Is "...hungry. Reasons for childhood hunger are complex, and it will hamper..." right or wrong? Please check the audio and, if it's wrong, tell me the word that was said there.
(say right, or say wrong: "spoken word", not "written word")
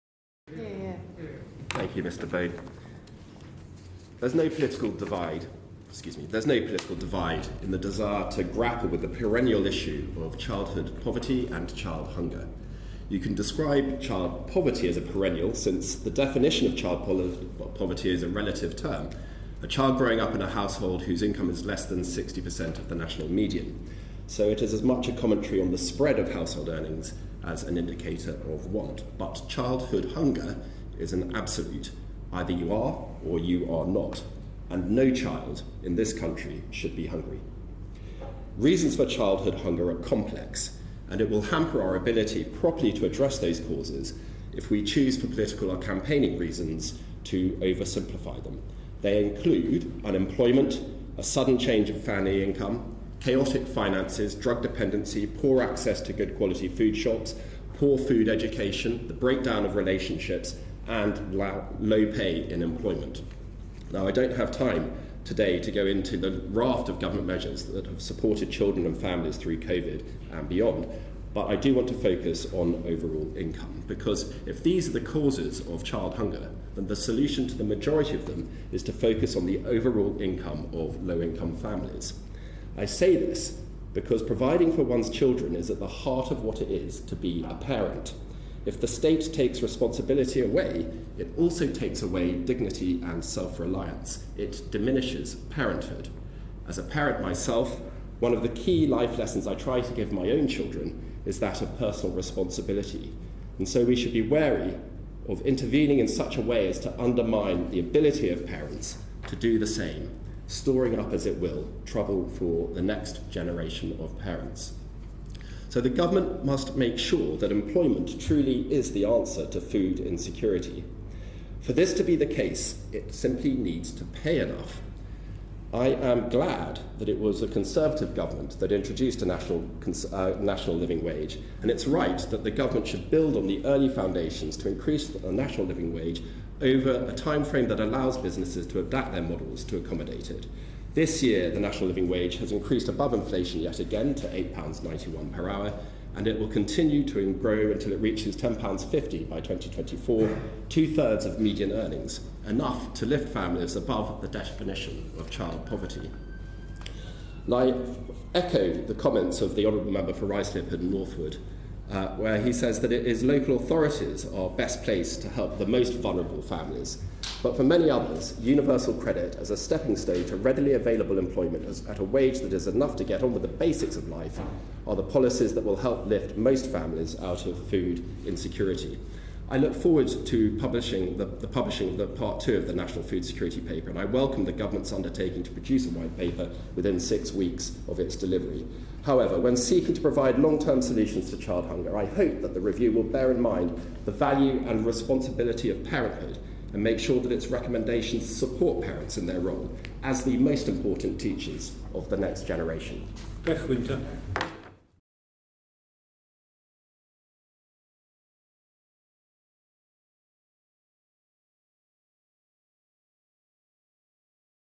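right.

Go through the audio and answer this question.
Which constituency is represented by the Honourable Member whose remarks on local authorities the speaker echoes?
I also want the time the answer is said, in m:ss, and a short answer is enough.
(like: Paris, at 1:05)
Ruislip and Northwood, at 2:40.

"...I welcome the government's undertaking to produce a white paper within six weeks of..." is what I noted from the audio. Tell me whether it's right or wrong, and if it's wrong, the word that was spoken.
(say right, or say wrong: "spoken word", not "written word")
right.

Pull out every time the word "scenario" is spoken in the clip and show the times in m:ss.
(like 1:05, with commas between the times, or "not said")
not said.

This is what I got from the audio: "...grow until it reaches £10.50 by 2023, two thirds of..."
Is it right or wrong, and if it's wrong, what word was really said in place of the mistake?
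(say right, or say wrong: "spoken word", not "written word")
wrong: "2024", not "2023".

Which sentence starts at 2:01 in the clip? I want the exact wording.
For this to be the case, it simply needs to pay enough.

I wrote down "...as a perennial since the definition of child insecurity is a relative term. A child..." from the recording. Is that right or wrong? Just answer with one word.
wrong.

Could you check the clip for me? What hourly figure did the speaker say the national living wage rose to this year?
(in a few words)
£8.91.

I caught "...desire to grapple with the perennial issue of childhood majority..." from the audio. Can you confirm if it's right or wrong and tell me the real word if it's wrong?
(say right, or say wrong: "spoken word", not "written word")
wrong: "poverty", not "majority".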